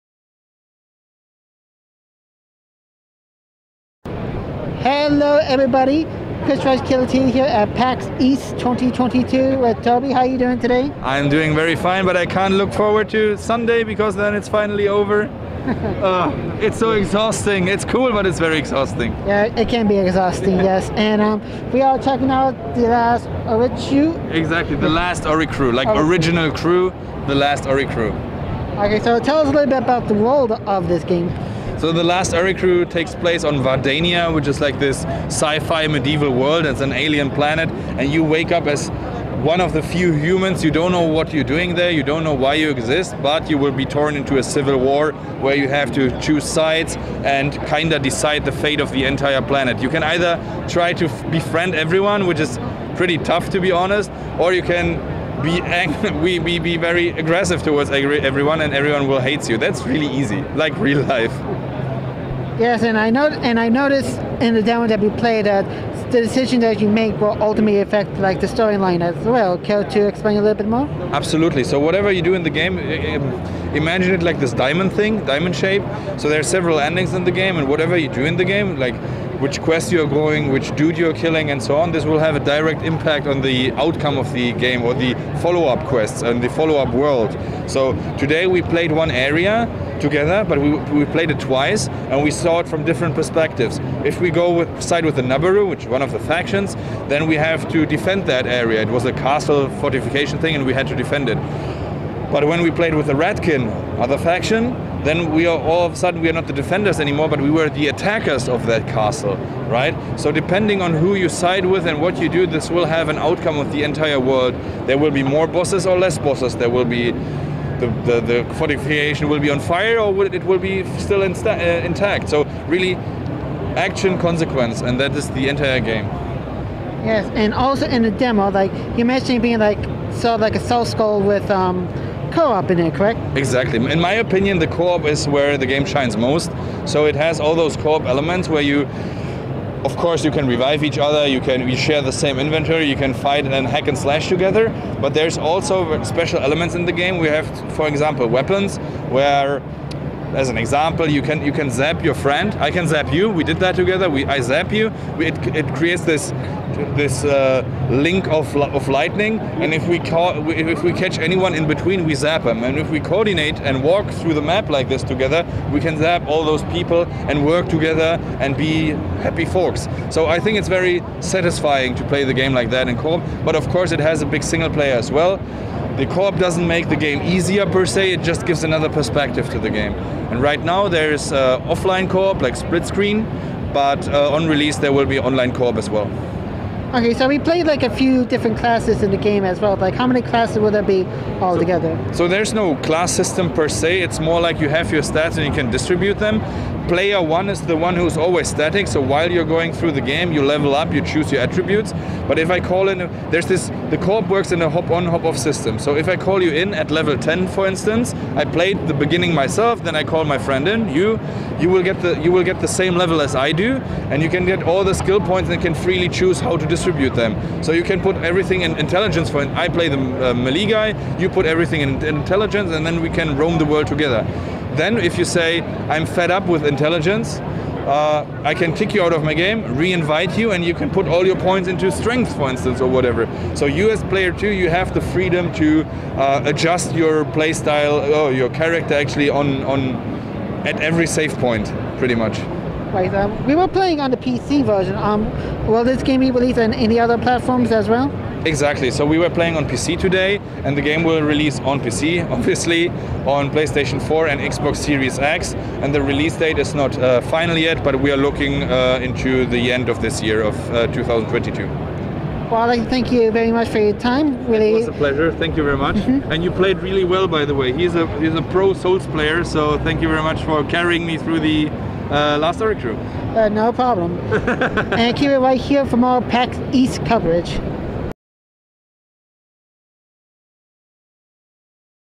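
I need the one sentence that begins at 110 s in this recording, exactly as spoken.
So depending on who you side with and what you do, this will have an outcome of the entire world.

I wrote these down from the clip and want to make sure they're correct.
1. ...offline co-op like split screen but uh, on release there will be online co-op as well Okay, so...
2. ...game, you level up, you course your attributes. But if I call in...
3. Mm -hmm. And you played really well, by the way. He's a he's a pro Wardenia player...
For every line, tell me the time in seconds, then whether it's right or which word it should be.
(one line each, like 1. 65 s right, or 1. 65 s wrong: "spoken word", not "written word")
1. 181 s right
2. 200 s wrong: "choose", not "course"
3. 265 s wrong: "Souls", not "Wardenia".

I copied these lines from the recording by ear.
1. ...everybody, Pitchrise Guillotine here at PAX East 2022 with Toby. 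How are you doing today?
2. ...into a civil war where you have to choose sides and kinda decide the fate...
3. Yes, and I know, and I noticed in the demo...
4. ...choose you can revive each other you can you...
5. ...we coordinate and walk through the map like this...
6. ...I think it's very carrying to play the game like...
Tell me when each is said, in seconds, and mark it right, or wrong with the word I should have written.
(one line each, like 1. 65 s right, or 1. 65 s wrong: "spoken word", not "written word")
1. 5 s right
2. 44 s right
3. 62 s right
4. 139 s wrong: "course", not "choose"
5. 162 s right
6. 170 s wrong: "satisfying", not "carrying".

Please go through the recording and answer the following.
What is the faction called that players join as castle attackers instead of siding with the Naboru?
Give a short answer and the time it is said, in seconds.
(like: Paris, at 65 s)
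Ratkin, at 103 s.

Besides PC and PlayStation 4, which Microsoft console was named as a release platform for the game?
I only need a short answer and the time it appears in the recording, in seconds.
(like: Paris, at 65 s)
Xbox Series X, at 254 s.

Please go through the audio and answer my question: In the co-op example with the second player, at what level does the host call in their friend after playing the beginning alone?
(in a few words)
Level 10.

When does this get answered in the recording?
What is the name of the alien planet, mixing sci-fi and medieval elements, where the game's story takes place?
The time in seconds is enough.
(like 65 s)
33 s.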